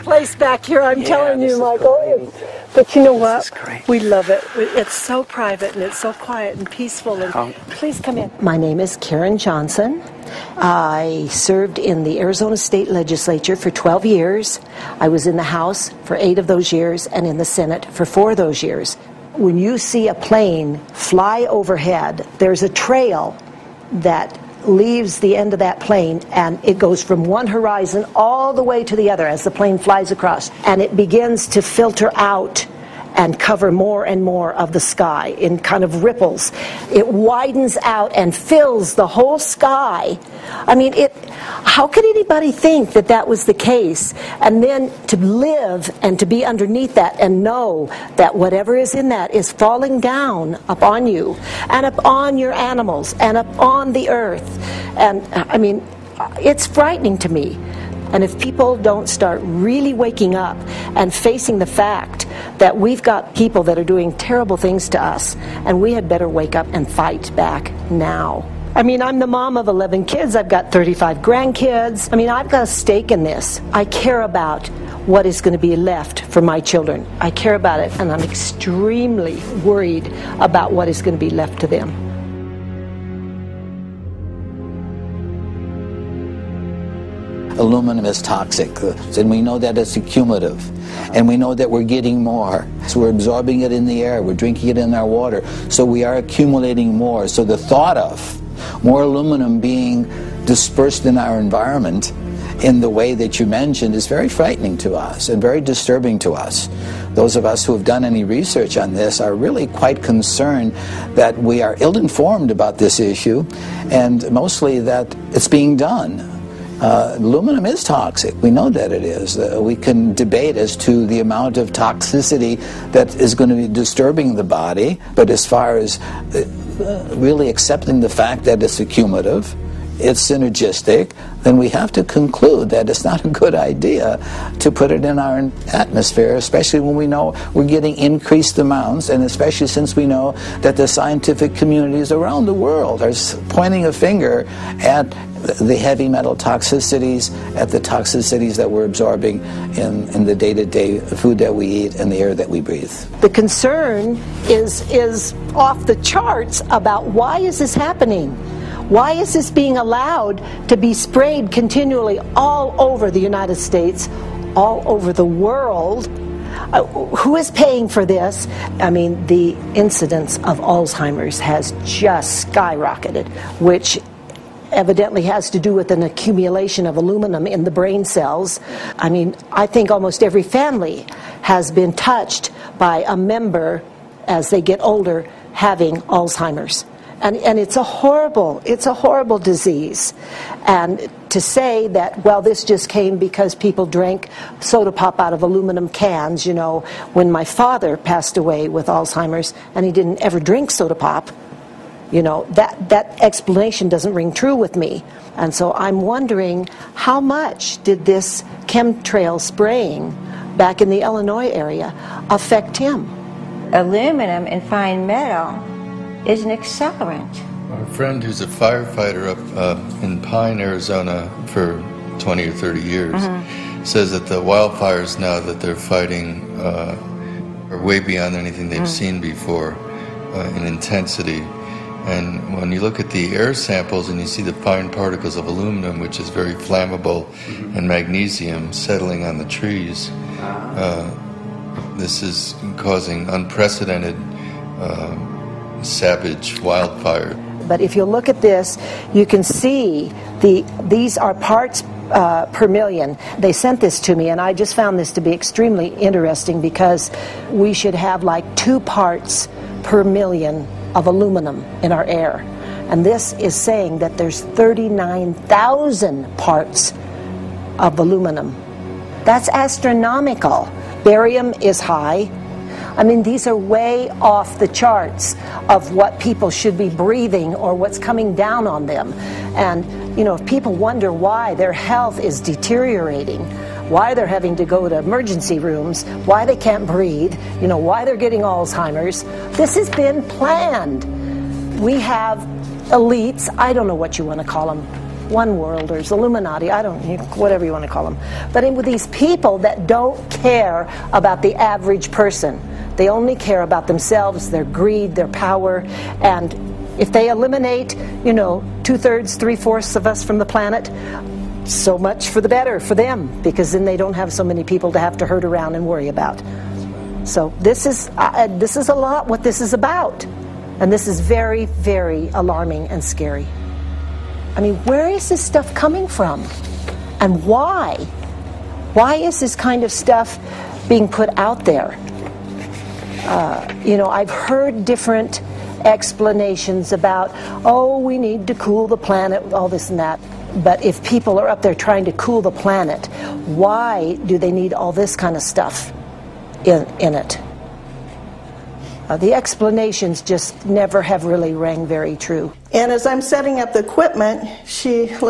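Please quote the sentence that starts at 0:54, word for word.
And I mean, it's frightening to me.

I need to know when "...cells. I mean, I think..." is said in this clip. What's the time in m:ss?
2:58.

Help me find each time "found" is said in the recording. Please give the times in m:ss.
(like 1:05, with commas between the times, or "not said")
4:14.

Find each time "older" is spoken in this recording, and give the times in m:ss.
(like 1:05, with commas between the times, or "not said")
3:04.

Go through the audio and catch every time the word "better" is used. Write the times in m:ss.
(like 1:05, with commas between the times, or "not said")
1:06, 5:12.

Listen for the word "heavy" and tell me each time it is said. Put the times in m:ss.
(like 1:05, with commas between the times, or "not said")
2:25.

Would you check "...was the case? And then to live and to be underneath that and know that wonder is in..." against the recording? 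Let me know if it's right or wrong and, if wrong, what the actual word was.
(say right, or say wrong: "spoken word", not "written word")
wrong: "whatever", not "wonder".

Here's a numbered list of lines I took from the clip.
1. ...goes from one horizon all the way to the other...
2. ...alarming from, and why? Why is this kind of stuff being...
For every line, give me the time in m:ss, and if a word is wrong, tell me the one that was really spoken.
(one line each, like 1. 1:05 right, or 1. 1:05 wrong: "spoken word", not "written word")
1. 0:26 right
2. 5:25 wrong: "coming", not "alarming".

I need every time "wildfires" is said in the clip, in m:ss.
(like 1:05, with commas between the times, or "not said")
3:44, 4:06.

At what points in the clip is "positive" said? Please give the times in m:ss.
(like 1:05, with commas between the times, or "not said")
not said.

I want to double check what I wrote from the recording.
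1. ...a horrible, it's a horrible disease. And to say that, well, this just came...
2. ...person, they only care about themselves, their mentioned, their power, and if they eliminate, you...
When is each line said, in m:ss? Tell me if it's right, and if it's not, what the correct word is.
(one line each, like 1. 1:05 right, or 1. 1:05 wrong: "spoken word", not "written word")
1. 3:07 right
2. 5:02 wrong: "greed", not "mentioned".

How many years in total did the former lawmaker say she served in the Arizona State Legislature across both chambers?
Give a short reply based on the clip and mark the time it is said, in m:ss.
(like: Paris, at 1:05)
12 years, at 0:13.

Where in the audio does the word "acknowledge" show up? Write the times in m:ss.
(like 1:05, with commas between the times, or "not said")
not said.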